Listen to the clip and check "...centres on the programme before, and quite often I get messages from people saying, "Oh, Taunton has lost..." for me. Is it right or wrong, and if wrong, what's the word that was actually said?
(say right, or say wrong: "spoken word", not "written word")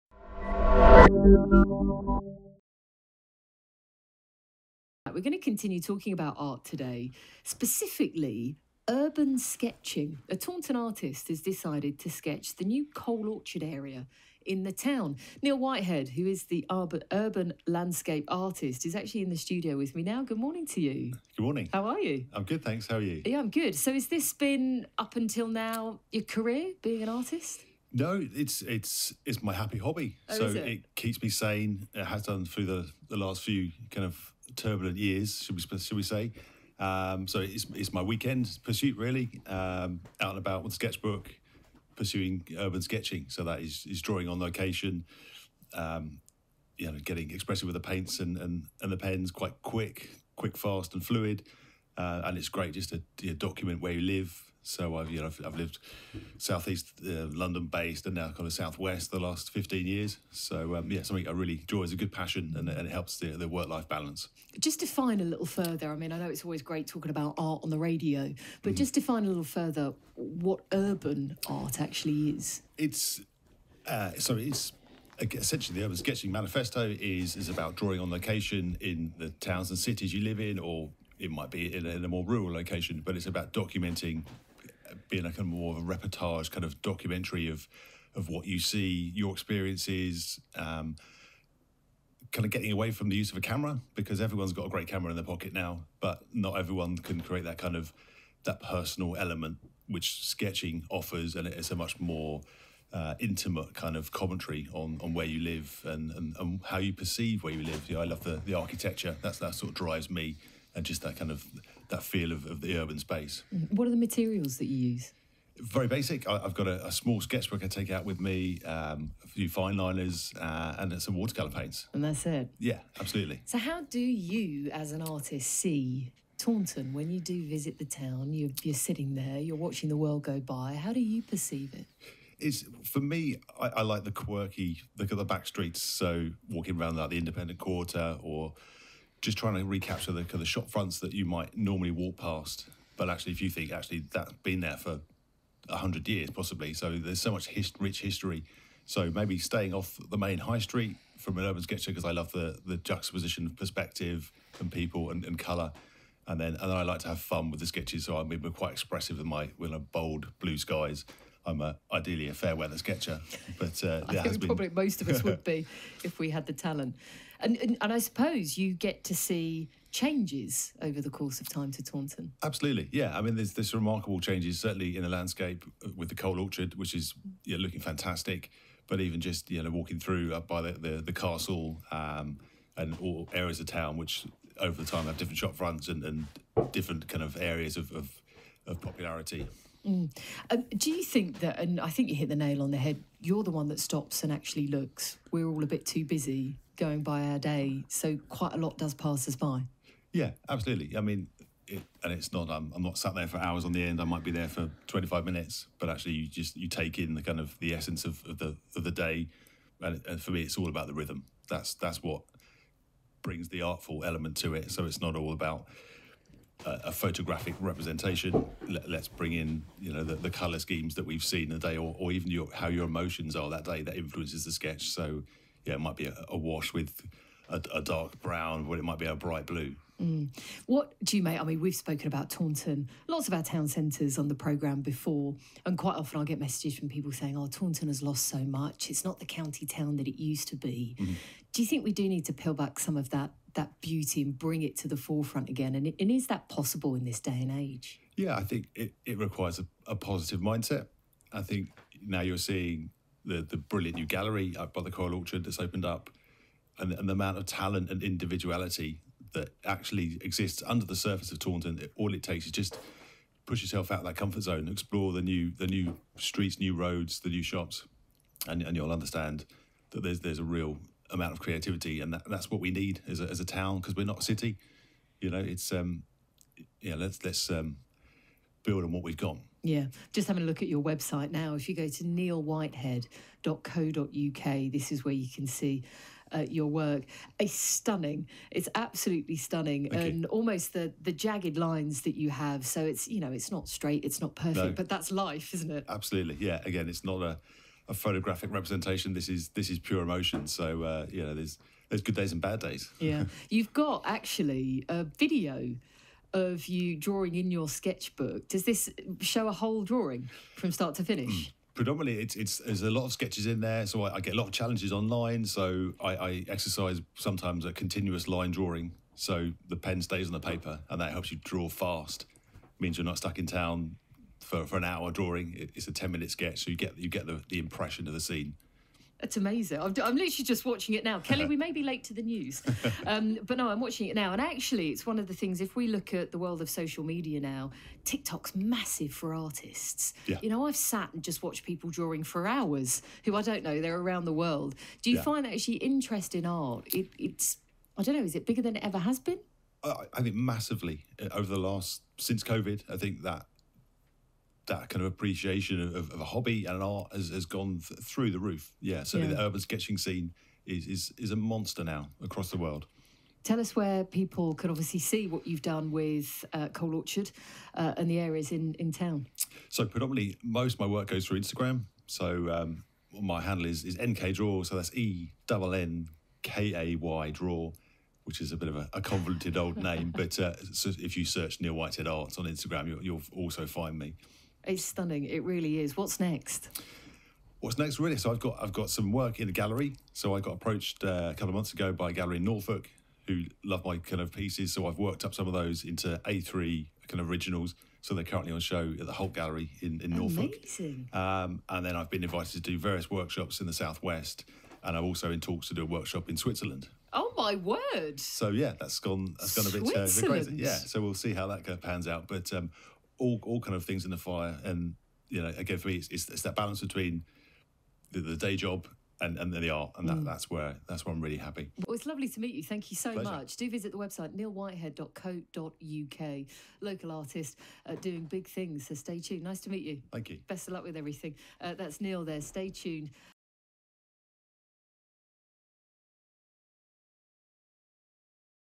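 right.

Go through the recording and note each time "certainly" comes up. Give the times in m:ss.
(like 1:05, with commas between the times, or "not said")
2:54, 5:59.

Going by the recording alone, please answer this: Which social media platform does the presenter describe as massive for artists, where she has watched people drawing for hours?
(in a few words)
TikTok.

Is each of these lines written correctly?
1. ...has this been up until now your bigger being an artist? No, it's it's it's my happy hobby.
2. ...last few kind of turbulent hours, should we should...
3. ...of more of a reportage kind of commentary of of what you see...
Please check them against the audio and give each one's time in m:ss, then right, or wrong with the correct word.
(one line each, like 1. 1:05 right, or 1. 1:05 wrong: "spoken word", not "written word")
1. 0:23 wrong: "career", not "bigger"
2. 0:33 wrong: "years", not "hours"
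3. 1:25 wrong: "documentary", not "commentary".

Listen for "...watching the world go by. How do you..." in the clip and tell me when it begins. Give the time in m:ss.
2:09.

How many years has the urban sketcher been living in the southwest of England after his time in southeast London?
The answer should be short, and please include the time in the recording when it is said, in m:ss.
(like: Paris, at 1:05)
15, at 0:59.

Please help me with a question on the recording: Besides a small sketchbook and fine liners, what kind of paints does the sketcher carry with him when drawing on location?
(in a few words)
Watercolour paints.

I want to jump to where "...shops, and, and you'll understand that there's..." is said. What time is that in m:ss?
4:27.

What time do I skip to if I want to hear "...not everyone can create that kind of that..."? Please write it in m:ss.
1:36.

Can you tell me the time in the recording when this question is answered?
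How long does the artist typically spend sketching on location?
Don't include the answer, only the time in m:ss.
3:24.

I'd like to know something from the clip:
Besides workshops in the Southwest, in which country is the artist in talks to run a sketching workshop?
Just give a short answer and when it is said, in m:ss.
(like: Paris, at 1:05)
Switzerland, at 6:46.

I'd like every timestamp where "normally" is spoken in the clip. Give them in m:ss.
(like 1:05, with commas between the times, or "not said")
2:21.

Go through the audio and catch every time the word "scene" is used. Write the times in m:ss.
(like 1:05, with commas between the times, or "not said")
5:28, 5:59.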